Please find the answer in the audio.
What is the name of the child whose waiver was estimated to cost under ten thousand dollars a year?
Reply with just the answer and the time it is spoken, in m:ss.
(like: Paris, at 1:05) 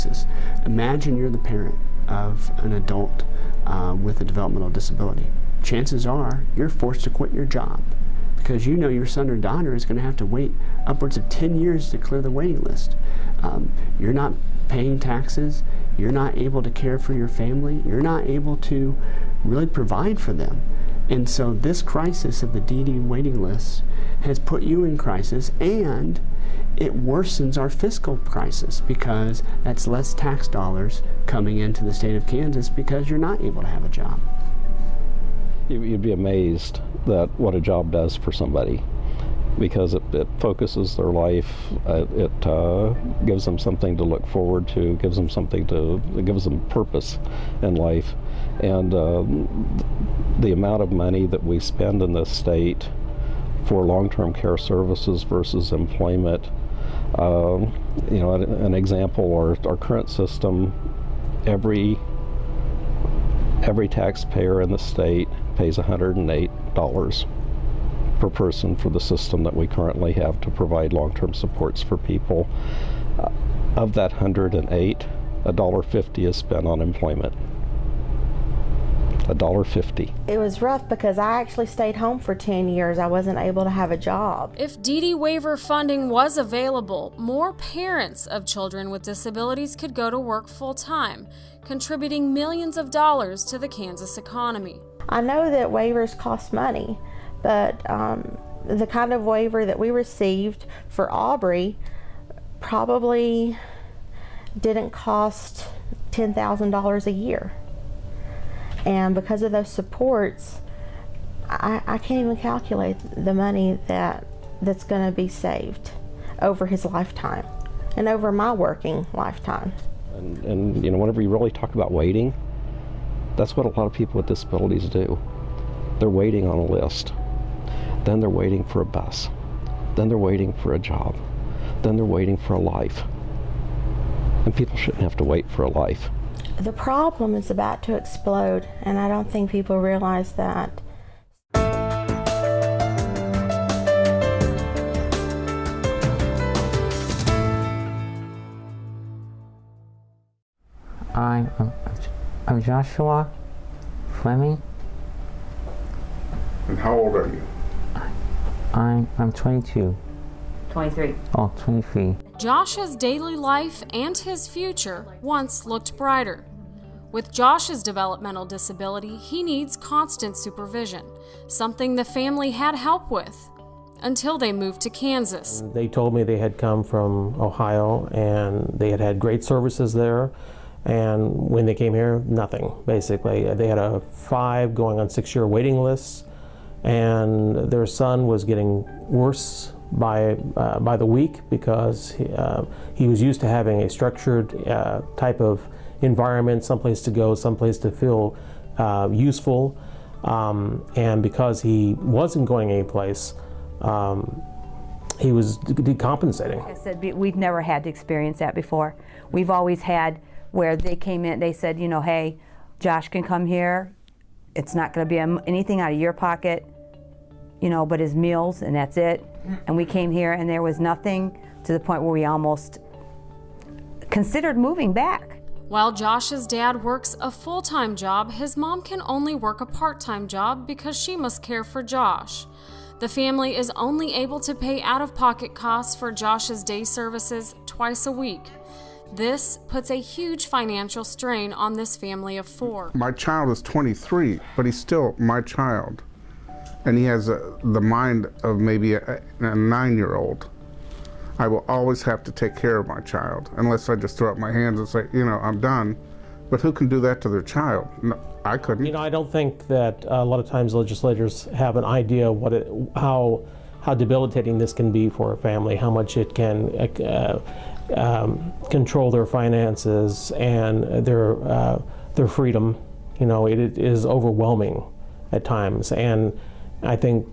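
Aubrey, at 1:41.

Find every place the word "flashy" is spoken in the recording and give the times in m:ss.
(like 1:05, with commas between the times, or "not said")
not said.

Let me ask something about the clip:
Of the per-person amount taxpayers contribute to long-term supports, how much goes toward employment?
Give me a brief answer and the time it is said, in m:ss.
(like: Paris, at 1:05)
$1.50, at 1:19.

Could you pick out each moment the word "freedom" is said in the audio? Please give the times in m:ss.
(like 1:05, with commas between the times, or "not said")
4:32.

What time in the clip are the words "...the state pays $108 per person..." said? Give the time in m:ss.
1:04.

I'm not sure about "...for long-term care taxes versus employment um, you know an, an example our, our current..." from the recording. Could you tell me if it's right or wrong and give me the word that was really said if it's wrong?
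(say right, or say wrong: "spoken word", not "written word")
wrong: "services", not "taxes".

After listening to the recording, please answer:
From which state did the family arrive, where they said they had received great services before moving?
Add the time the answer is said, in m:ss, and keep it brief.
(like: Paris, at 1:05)
Ohio, at 2:57.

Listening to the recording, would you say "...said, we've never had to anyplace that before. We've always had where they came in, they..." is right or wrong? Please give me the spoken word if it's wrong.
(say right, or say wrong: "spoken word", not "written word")
wrong: "experience", not "anyplace".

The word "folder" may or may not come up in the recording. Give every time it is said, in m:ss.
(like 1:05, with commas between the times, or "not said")
not said.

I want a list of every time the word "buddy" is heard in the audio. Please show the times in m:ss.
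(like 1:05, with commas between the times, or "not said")
not said.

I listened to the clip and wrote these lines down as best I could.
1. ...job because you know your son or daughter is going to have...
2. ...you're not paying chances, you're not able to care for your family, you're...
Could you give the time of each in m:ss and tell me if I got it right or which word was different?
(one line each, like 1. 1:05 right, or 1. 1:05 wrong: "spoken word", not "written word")
1. 0:07 right
2. 0:13 wrong: "taxes", not "chances".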